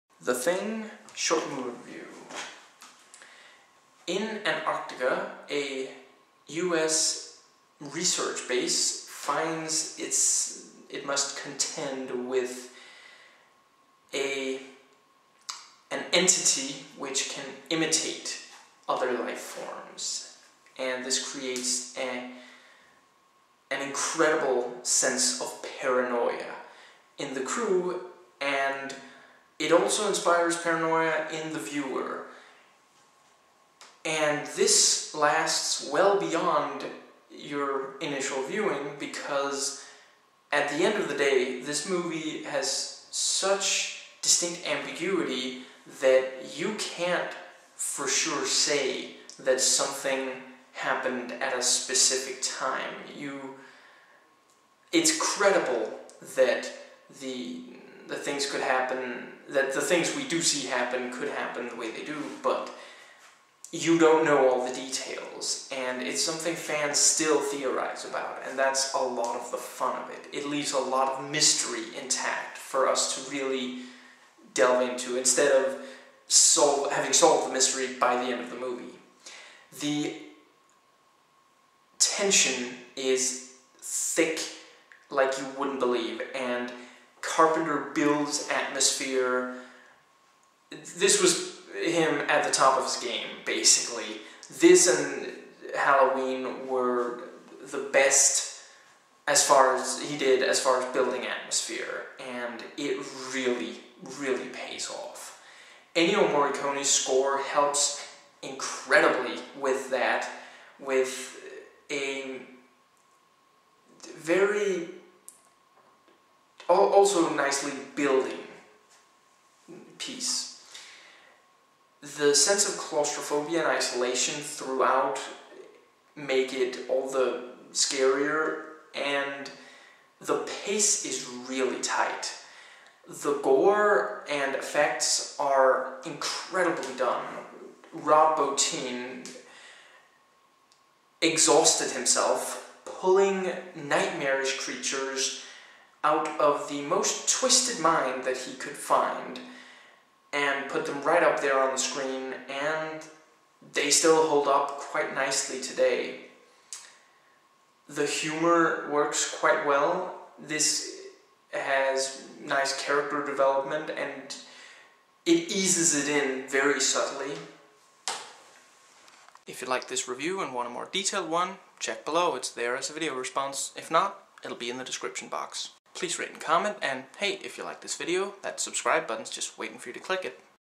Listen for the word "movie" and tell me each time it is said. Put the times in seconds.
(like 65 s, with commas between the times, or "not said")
1 s, 41 s, 78 s.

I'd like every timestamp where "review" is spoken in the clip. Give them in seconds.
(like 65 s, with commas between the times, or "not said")
1 s, 170 s.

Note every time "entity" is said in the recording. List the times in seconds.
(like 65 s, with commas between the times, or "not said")
16 s.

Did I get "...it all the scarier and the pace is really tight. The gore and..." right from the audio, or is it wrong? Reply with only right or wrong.
right.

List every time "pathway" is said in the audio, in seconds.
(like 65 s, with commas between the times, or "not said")
not said.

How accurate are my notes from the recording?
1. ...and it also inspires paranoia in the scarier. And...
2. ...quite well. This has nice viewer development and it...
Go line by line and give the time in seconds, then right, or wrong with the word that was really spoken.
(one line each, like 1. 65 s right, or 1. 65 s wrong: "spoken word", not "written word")
1. 28 s wrong: "viewer", not "scarier"
2. 159 s wrong: "character", not "viewer".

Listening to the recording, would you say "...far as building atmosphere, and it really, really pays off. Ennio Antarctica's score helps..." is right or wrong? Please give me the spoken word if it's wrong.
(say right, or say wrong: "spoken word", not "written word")
wrong: "Morricone", not "Antarctica".